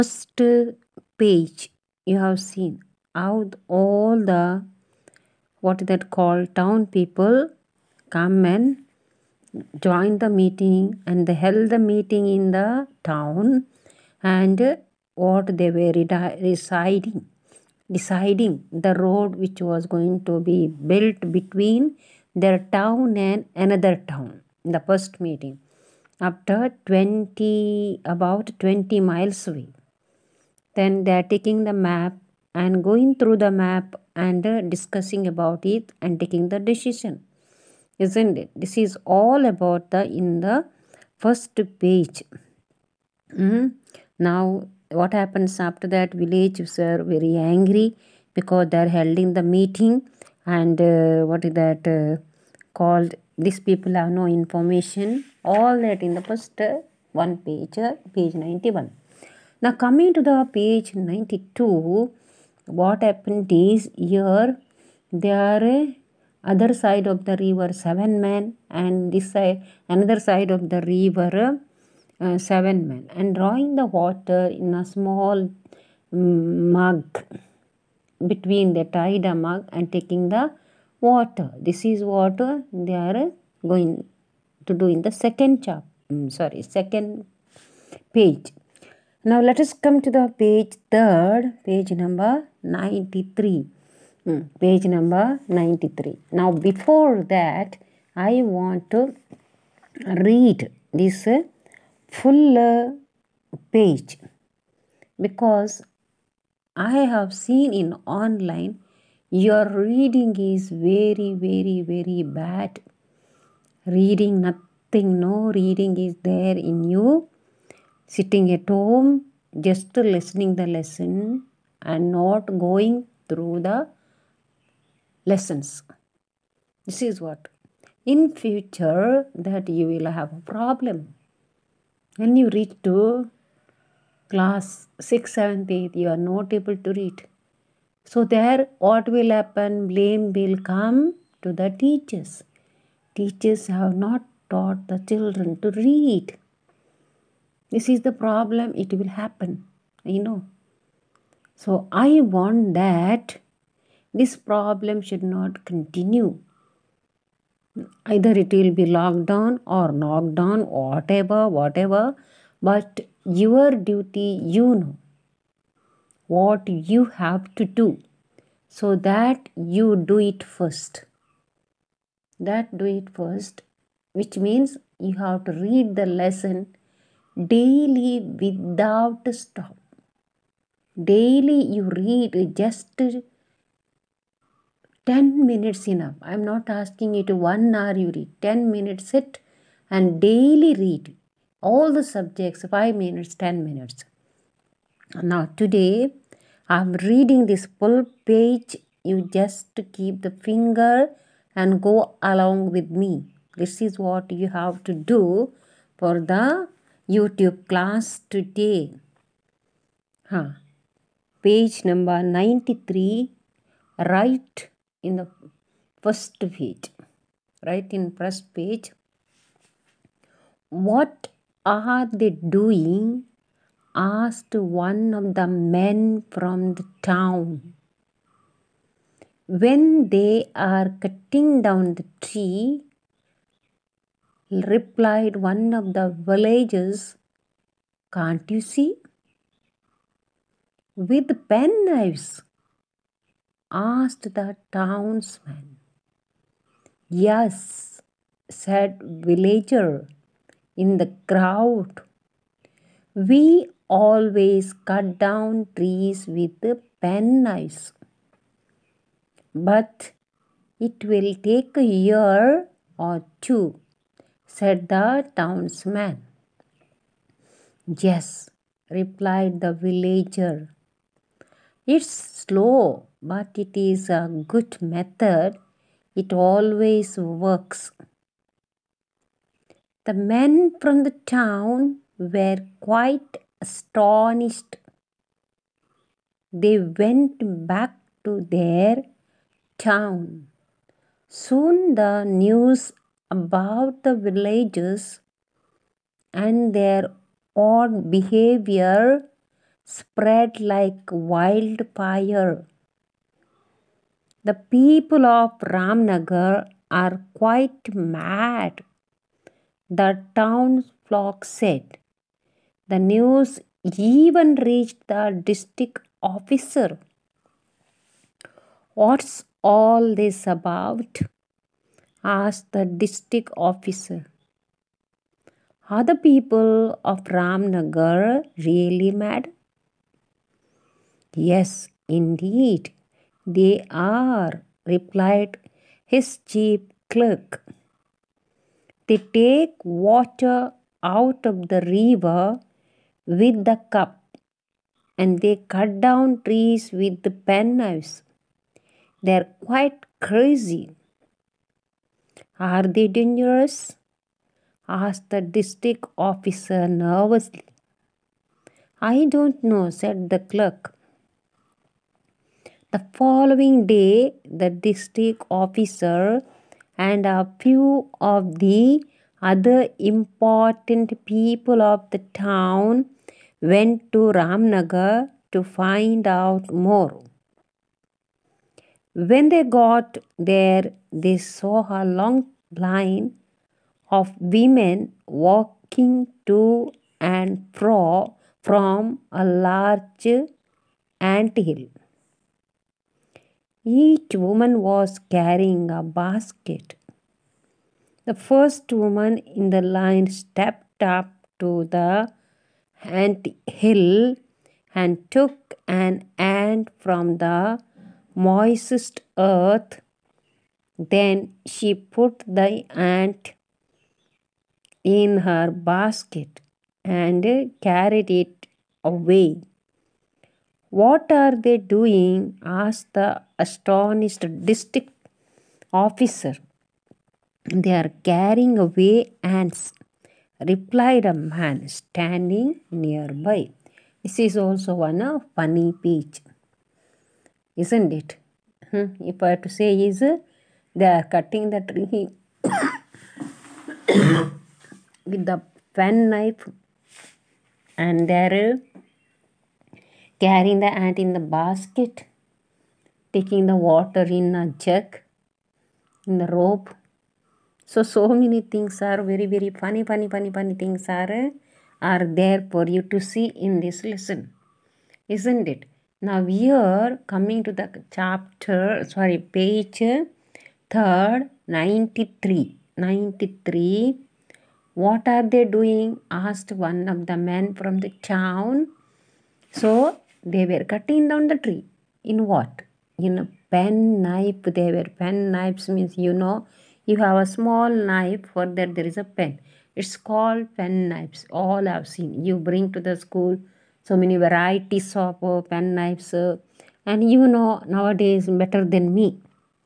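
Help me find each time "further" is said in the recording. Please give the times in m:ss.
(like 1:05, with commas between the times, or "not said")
not said.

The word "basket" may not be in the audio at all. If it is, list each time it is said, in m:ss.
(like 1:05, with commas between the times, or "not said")
6:36, 6:55, 7:31.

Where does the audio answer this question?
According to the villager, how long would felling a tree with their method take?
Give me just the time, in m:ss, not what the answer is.
4:21.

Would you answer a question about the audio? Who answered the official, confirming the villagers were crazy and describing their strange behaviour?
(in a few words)
Chief clerk.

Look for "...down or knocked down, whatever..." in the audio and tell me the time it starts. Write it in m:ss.
2:39.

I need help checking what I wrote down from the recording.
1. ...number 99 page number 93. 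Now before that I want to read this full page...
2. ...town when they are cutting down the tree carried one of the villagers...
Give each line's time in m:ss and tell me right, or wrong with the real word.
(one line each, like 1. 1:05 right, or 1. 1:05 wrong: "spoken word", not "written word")
1. 1:32 wrong: "93", not "99"
2. 3:47 wrong: "replied", not "carried".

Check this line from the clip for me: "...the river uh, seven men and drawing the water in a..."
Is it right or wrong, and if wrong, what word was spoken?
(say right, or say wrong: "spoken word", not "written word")
right.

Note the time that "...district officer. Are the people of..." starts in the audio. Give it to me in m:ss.
5:23.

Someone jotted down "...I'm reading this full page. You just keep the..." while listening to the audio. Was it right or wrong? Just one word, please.
right.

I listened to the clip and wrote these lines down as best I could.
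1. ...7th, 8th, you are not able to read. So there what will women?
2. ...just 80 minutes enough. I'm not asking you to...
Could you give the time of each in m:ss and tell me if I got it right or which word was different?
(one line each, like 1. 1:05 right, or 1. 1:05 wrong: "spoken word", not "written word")
1. 2:15 wrong: "happen", not "women"
2. 3:02 wrong: "10", not "80".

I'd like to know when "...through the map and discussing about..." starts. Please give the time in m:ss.
0:33.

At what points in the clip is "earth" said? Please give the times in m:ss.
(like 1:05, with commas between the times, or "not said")
6:49.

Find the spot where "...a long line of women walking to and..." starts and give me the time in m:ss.
6:22.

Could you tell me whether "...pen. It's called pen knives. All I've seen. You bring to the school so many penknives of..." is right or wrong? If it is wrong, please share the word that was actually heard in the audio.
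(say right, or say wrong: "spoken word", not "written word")
wrong: "varieties", not "penknives".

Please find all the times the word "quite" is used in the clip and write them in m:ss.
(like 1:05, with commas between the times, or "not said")
4:42, 5:07, 5:49.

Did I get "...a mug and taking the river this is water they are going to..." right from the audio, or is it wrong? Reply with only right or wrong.
wrong.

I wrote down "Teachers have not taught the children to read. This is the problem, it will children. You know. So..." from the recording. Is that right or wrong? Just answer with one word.
wrong.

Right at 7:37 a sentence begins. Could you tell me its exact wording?
So, so many things are very, very funny, funny, funny, funny things are, are there for you to see in this lesson.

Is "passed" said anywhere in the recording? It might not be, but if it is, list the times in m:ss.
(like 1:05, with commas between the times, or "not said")
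not said.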